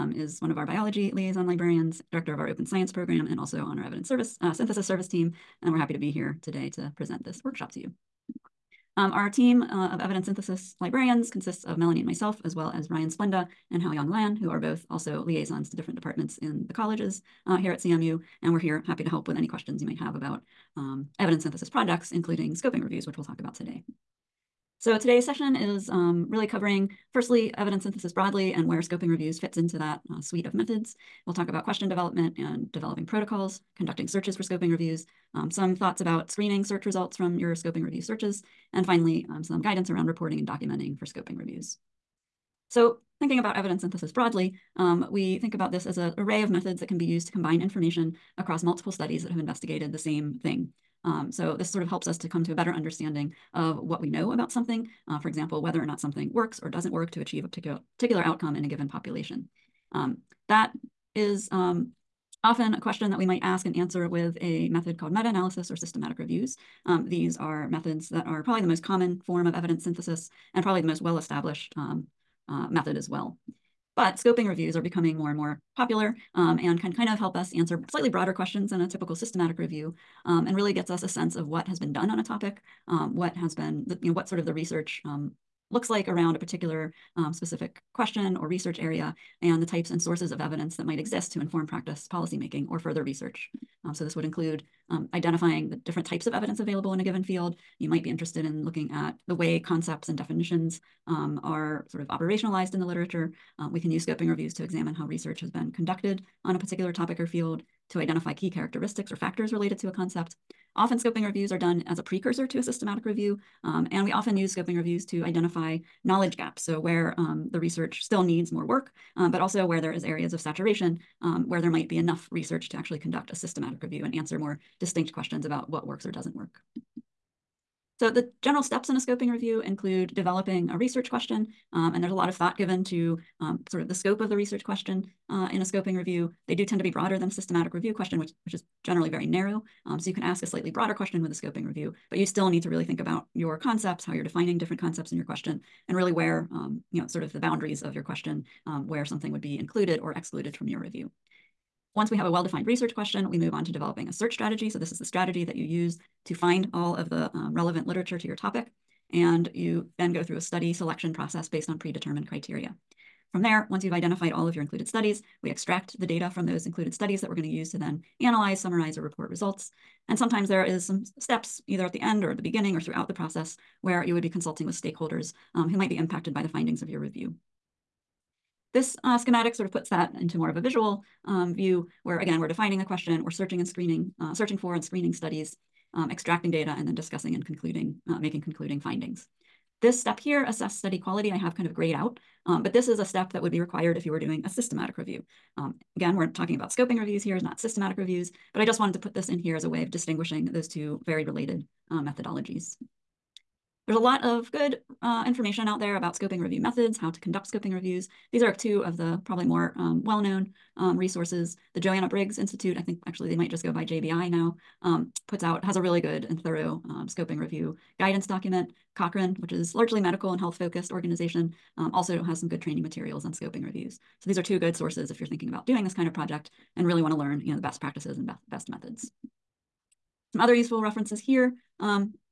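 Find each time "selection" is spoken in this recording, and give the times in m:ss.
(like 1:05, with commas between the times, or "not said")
2:40.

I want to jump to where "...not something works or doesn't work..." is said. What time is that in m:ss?
0:55.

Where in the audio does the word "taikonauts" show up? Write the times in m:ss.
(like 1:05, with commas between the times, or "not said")
not said.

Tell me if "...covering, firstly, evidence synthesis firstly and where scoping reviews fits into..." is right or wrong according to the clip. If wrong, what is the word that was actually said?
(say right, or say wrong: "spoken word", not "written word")
wrong: "broadly", not "firstly".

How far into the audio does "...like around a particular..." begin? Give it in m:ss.
1:25.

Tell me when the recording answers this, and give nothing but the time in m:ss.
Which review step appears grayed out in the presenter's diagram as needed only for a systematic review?
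3:10.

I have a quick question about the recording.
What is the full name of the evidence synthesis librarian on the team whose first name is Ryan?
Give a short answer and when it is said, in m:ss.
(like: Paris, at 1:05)
Ryan Splenda, at 0:12.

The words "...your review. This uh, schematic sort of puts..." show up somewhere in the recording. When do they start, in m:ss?
2:56.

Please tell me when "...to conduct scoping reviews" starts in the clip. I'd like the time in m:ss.
3:27.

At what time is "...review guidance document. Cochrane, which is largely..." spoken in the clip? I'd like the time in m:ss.
3:37.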